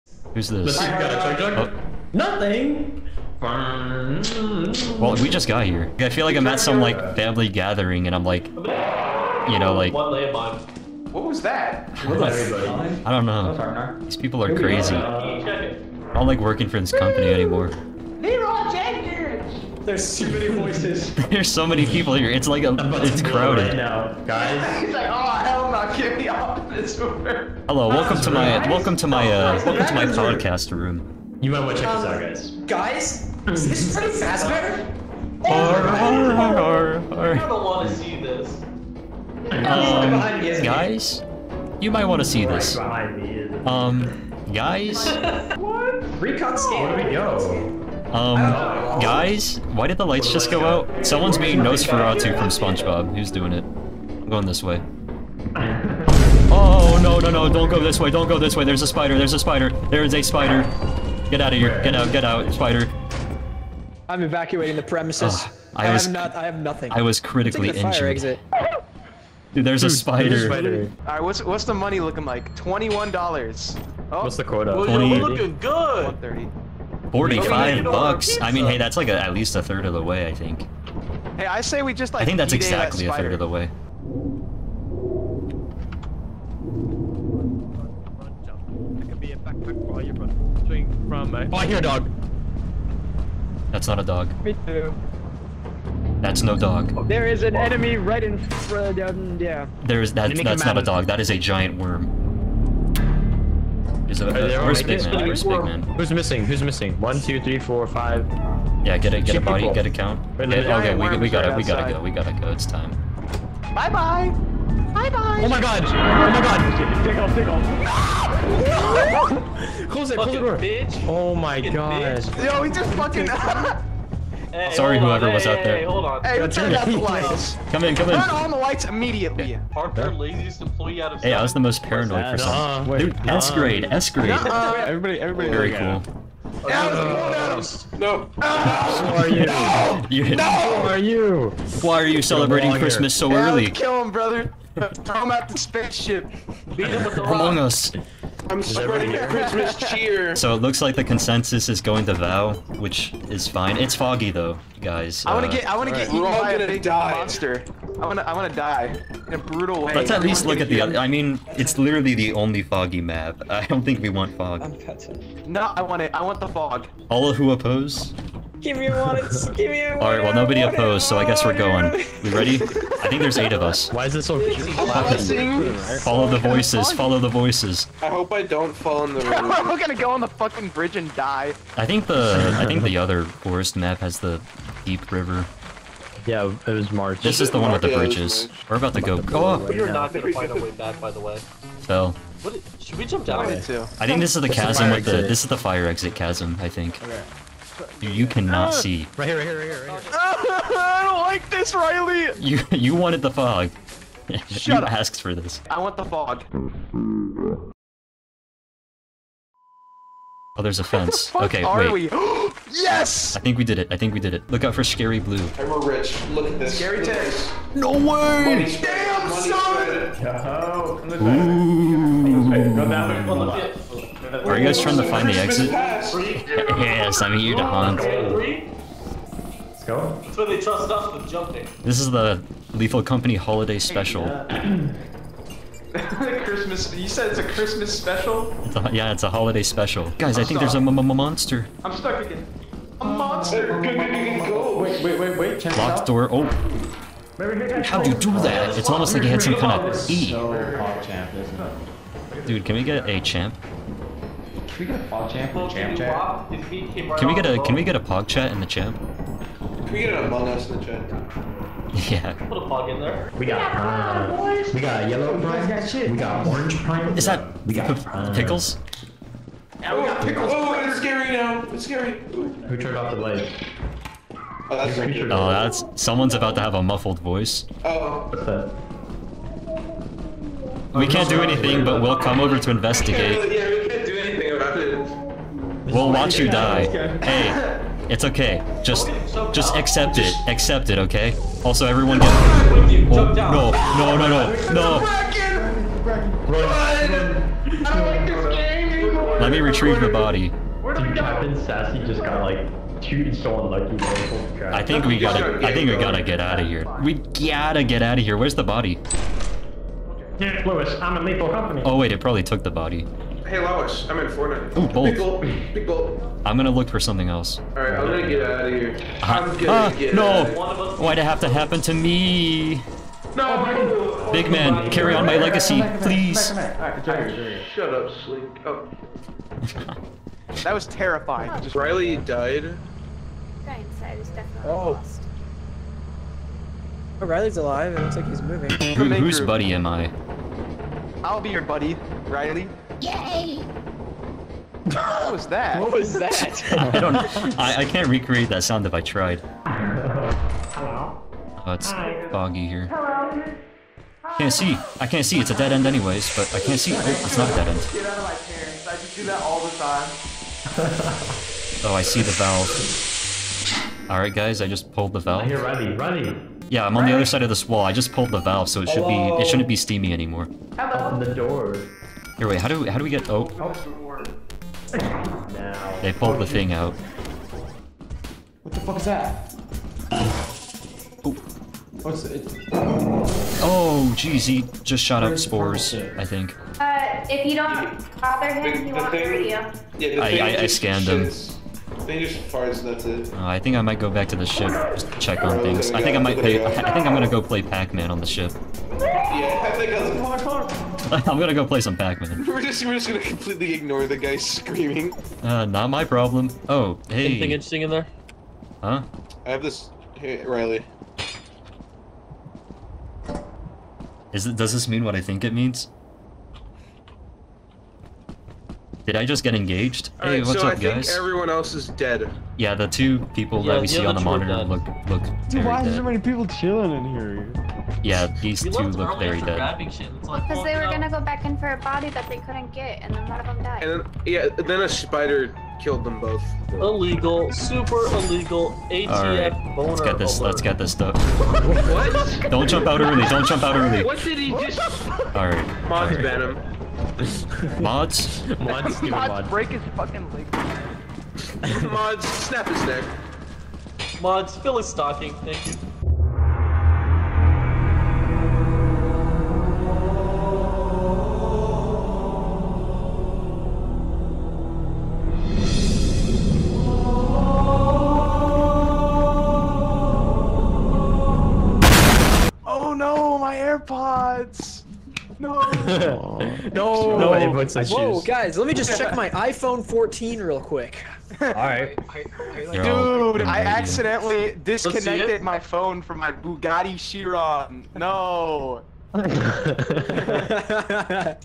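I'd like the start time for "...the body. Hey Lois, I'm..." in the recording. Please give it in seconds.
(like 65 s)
312 s.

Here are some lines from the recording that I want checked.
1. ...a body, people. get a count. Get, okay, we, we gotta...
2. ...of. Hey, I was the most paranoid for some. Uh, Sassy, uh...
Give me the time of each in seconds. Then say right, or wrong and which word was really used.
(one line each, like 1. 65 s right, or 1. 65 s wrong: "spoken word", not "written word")
1. 109 s right
2. 131 s wrong: "Dude", not "Sassy".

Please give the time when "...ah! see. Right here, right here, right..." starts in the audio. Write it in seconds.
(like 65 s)
198 s.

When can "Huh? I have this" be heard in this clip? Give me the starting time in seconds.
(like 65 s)
408 s.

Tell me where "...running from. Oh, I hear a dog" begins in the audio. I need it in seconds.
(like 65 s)
91 s.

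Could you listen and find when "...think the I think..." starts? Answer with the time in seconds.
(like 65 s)
181 s.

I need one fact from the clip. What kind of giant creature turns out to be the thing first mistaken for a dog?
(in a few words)
A giant worm.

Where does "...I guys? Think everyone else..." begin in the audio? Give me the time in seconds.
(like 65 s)
420 s.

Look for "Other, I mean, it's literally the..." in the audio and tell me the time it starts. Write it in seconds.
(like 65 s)
160 s.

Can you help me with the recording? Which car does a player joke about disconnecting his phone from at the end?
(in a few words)
Bugatti Chiron.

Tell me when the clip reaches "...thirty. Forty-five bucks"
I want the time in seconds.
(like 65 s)
76 s.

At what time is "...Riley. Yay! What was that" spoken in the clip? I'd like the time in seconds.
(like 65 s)
342 s.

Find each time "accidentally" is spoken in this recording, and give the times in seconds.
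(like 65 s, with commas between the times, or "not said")
483 s.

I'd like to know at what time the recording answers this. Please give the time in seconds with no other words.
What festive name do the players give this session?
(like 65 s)
232 s.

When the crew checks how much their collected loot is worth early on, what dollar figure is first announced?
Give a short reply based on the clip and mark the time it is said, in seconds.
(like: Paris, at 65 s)
$21, at 72 s.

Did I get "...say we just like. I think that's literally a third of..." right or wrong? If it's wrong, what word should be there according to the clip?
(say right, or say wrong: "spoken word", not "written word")
wrong: "exactly", not "literally".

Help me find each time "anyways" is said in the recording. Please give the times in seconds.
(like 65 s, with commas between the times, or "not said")
355 s.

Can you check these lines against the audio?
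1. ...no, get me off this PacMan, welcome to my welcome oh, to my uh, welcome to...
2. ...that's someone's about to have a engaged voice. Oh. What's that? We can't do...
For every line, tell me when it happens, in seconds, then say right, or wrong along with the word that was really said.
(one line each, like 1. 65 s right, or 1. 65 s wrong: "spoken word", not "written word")
1. 25 s wrong: "Hello", not "PacMan"
2. 275 s wrong: "muffled", not "engaged".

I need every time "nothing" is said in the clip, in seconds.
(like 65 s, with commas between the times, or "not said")
2 s, 66 s.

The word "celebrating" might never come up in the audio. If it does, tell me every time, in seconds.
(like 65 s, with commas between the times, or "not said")
142 s.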